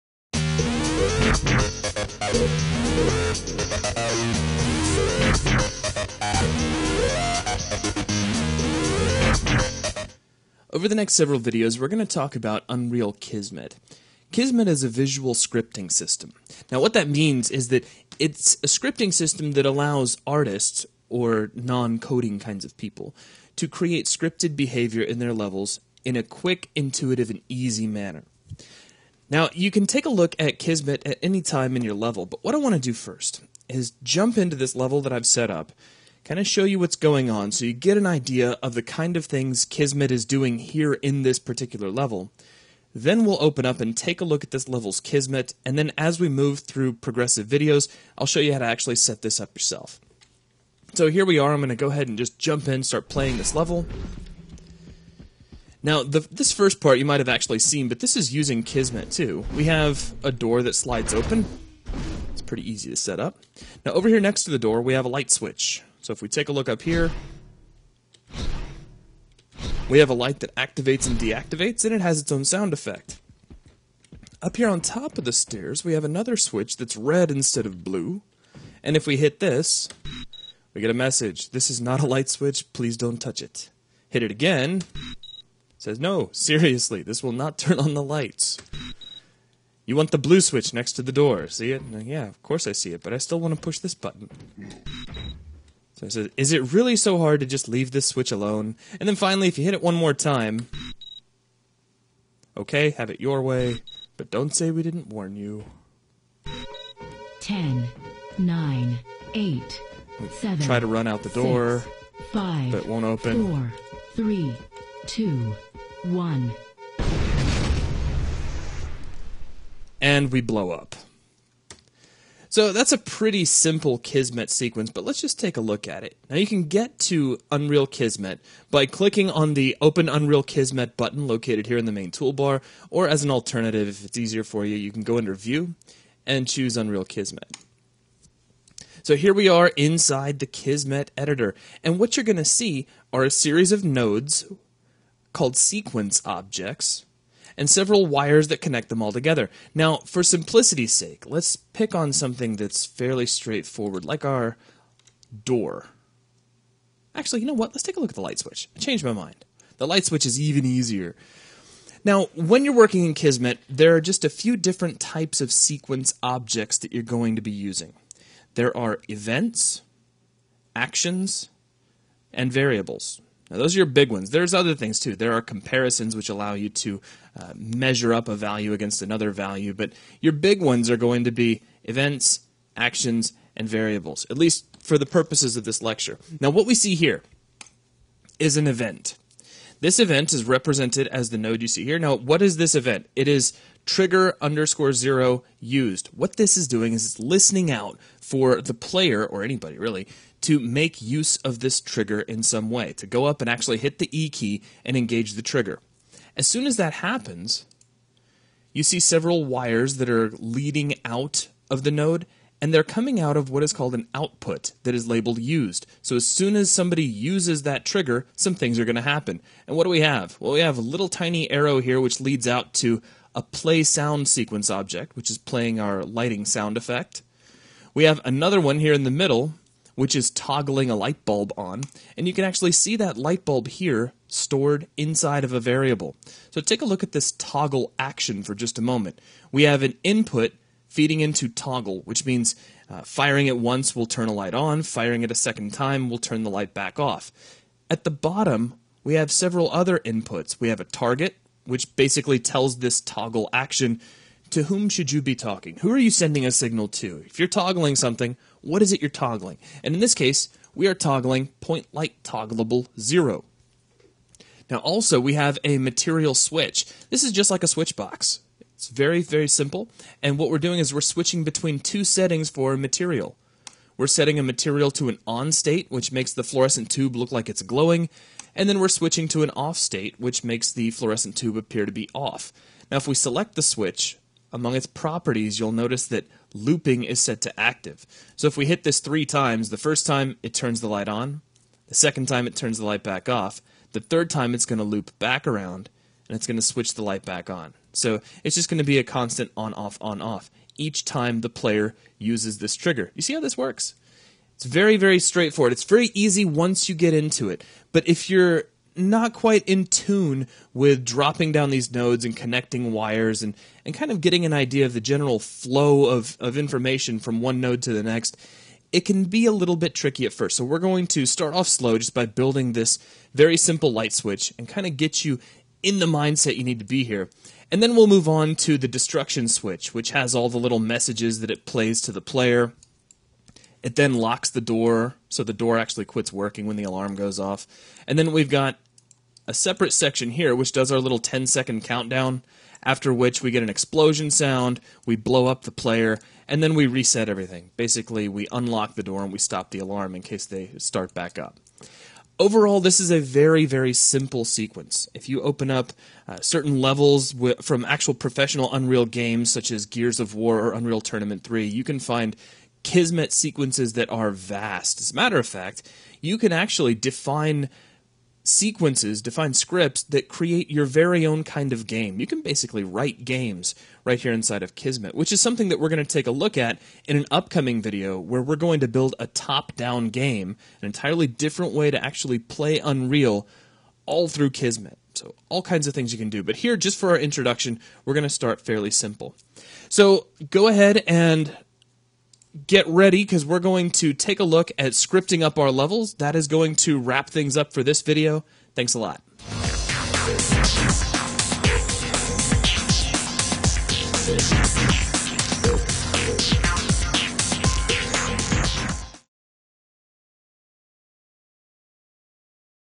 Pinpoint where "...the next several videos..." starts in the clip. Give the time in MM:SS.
00:10.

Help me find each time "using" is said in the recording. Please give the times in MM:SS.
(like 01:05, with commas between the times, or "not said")
00:58, 02:47.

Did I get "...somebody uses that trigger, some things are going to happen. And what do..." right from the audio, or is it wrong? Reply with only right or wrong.
right.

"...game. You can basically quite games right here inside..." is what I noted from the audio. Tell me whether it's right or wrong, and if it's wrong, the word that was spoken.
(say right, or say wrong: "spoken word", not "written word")
wrong: "write", not "quite".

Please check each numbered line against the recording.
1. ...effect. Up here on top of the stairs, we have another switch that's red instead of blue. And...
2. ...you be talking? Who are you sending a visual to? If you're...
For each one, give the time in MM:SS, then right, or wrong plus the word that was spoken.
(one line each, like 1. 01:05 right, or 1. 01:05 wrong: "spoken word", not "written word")
1. 01:12 right
2. 04:15 wrong: "signal", not "visual".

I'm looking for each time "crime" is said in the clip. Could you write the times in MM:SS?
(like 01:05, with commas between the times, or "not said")
not said.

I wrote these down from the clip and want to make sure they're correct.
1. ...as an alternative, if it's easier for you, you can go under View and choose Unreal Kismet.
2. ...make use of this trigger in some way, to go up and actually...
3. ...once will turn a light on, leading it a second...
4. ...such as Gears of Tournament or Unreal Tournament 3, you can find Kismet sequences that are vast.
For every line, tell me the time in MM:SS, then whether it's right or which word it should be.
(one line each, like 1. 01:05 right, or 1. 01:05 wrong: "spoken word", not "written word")
1. 02:13 right
2. 03:20 right
3. 04:03 wrong: "firing", not "leading"
4. 05:59 wrong: "War", not "Tournament".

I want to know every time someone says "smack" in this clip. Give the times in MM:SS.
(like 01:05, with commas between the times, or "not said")
not said.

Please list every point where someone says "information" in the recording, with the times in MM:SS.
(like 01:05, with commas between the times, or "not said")
05:16.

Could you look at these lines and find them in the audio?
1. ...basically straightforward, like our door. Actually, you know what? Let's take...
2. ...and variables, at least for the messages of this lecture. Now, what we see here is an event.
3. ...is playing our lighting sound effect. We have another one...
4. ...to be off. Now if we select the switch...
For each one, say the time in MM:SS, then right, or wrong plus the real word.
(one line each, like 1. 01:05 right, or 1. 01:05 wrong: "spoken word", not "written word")
1. 02:32 wrong: "fairly", not "basically"
2. 03:03 wrong: "purposes", not "messages"
3. 03:45 right
4. 04:41 right.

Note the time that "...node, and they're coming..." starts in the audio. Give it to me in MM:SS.
03:31.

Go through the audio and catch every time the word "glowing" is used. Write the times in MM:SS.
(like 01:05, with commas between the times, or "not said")
04:37.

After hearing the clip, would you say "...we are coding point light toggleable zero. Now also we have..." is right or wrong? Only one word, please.
wrong.